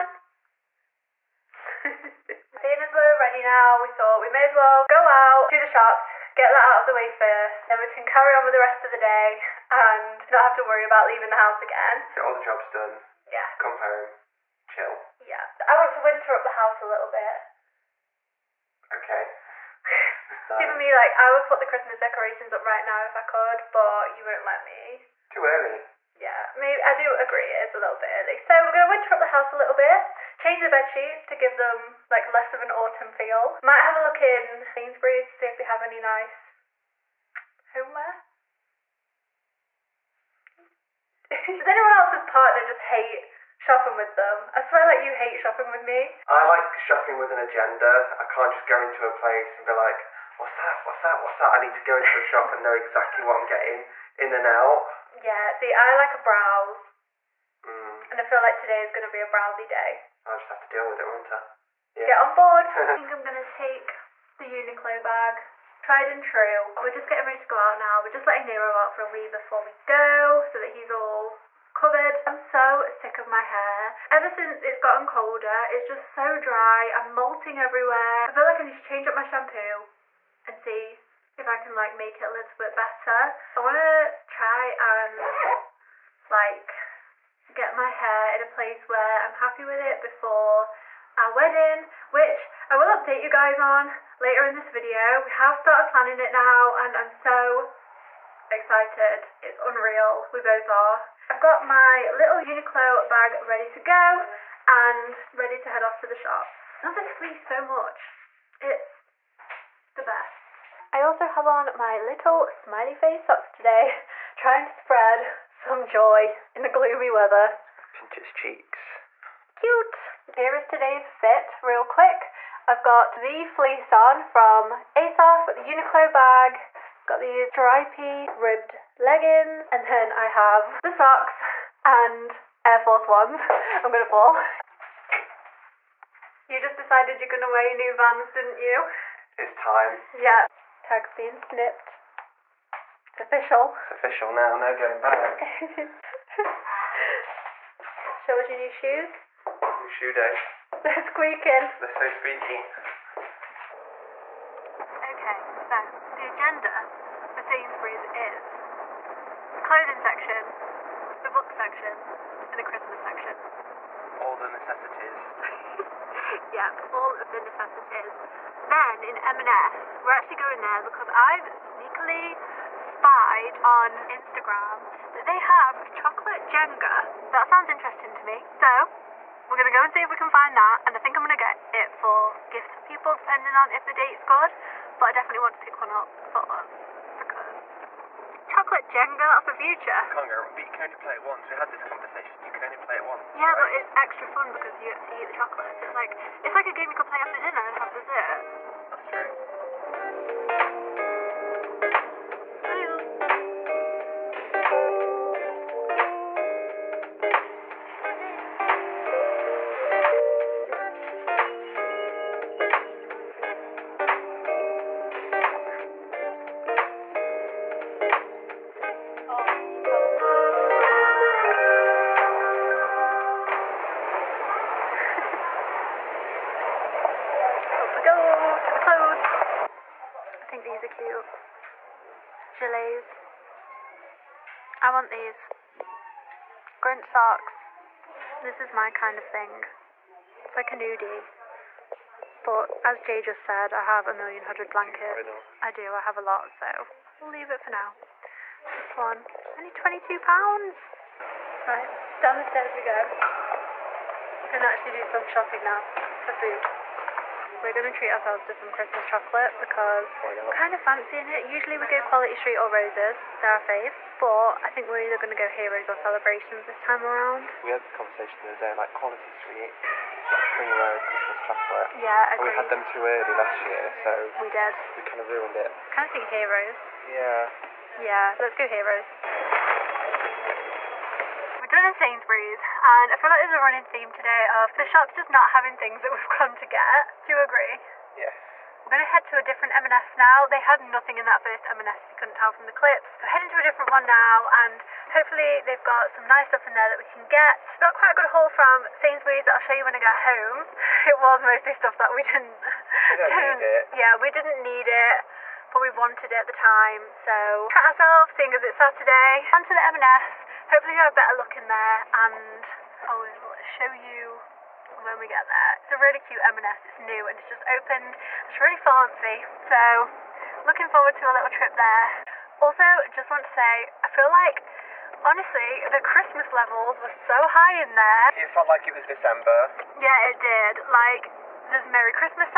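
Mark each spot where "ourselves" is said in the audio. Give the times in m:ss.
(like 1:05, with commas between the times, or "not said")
4:18, 5:07.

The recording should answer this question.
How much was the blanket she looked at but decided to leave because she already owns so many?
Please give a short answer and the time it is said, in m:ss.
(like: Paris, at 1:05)
22 pounds, at 4:09.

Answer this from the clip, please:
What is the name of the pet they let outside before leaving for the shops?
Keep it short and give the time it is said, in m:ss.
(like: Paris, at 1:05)
Nero, at 1:08.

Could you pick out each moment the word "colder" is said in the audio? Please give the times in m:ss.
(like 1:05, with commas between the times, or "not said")
1:15.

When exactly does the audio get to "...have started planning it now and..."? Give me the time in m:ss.
1:35.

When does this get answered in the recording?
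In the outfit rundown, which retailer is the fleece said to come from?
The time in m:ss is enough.
2:04.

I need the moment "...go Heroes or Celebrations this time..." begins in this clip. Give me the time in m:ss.
4:25.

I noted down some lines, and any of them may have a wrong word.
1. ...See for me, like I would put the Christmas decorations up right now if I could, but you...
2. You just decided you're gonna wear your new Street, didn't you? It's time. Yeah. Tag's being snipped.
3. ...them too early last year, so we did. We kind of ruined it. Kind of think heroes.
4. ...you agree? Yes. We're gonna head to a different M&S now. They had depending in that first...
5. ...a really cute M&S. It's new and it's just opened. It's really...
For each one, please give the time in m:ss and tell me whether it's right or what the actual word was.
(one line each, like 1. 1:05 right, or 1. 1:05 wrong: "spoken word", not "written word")
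1. 0:20 right
2. 2:16 wrong: "Vans", not "Street"
3. 4:32 right
4. 4:47 wrong: "nothing", not "depending"
5. 5:15 right.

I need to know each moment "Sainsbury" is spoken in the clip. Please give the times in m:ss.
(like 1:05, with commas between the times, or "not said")
0:34, 2:37, 4:41, 4:58.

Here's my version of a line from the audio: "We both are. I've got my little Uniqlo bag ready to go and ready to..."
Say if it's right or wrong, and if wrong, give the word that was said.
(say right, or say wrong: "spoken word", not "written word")
right.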